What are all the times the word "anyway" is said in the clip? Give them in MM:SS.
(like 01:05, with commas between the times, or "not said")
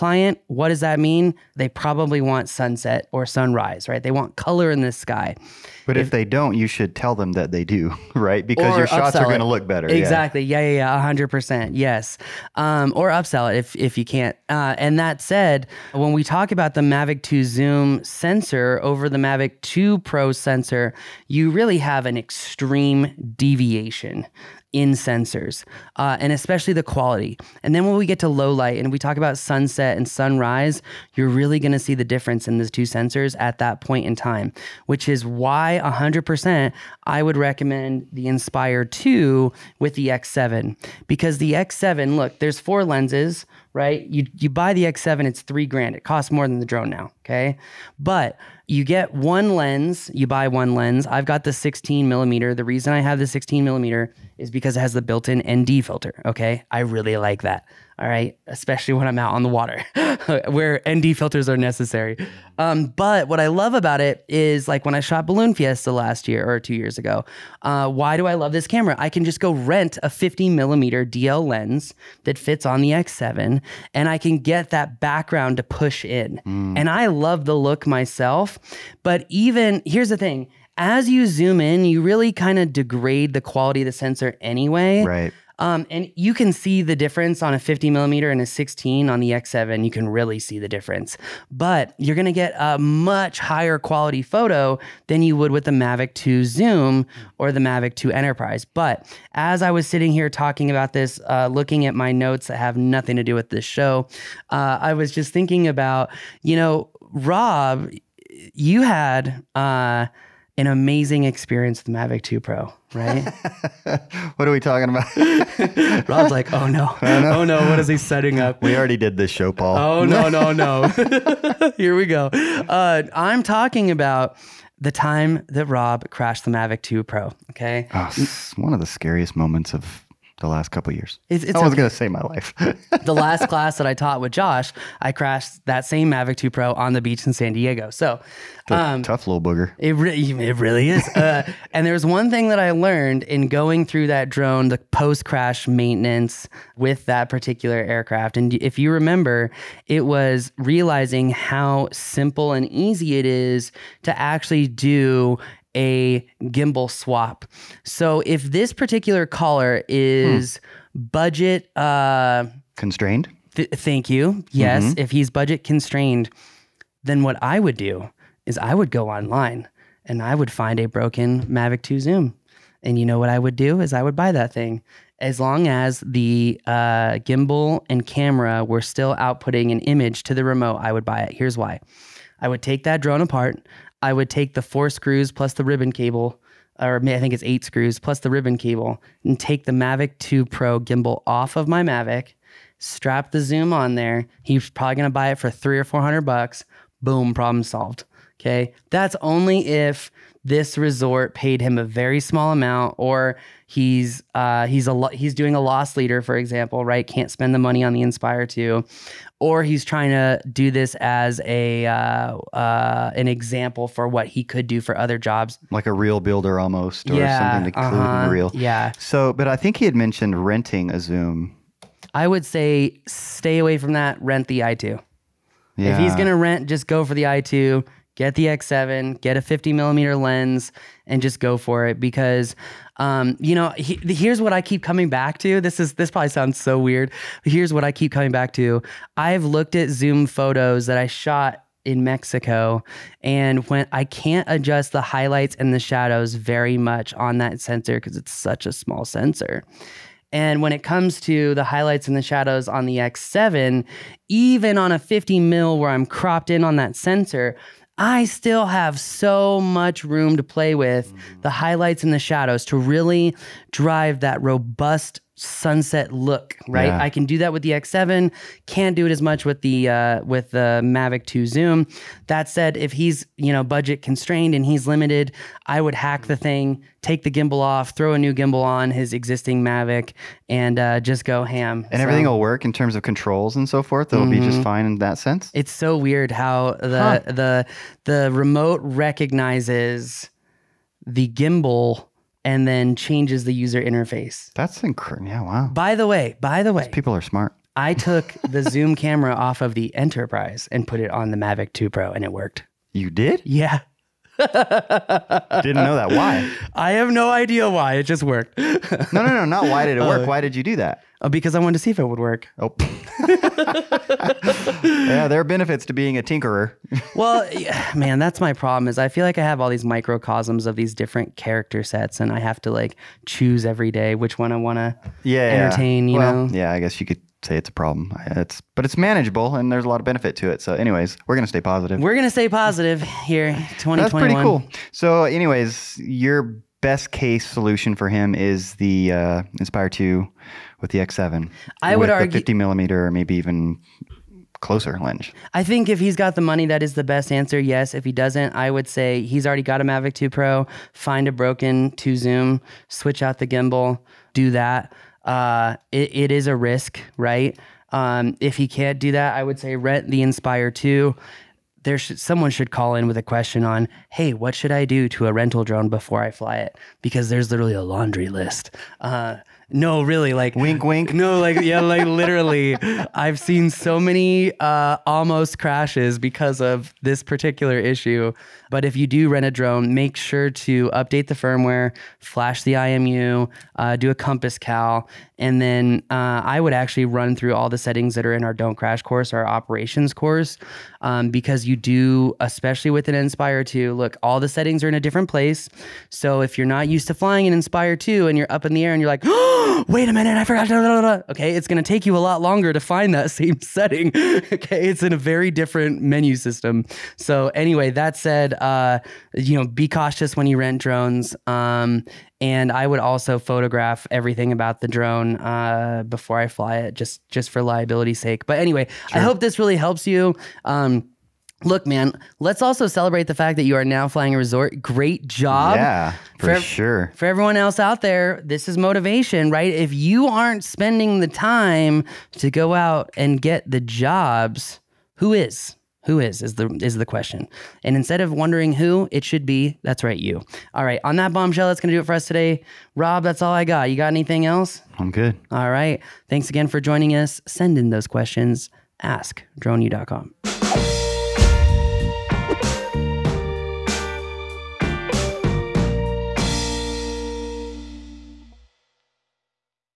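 01:24, 05:30, 05:35, 06:47, 06:58.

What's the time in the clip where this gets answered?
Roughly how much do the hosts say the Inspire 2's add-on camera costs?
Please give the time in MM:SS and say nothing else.
00:45.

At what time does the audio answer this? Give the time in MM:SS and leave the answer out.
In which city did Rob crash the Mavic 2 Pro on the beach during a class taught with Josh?
02:17.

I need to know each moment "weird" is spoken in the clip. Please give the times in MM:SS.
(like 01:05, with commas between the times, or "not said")
03:56, 04:45.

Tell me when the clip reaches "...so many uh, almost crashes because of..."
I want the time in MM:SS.
06:13.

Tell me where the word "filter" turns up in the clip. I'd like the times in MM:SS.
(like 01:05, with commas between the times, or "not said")
00:55, 01:01.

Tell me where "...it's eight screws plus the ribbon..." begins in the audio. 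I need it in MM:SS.
03:07.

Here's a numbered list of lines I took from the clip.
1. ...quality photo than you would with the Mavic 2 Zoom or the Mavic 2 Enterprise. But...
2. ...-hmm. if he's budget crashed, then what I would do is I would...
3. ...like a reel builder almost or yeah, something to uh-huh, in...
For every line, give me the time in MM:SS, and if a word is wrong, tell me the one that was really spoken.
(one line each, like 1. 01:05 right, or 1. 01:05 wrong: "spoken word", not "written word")
1. 01:33 right
2. 02:44 wrong: "constrained", not "crashed"
3. 03:35 right.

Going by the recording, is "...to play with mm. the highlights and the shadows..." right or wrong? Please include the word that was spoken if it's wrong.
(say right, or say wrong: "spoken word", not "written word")
right.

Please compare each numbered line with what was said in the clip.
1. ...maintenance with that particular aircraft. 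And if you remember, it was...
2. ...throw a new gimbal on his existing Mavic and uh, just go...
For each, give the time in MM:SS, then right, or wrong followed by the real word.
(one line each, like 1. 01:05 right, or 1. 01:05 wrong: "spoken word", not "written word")
1. 02:25 right
2. 04:37 right.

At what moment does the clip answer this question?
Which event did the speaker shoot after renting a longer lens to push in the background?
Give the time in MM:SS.
01:05.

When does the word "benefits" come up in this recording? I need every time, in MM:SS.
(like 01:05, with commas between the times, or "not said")
05:15, 05:30.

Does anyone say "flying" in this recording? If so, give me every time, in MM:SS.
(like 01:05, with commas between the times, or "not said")
06:37, 07:04.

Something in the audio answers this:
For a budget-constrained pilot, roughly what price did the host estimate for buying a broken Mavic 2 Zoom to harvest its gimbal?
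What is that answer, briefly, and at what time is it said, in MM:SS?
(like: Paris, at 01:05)
300 or 400 dollars, at 03:15.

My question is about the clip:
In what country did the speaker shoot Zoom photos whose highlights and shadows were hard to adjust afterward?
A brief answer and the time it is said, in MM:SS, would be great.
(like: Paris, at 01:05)
Mexico, at 04:02.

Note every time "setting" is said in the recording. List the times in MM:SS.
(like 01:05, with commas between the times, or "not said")
01:57, 06:27, 06:34, 06:43.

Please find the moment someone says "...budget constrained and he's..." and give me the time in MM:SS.
04:33.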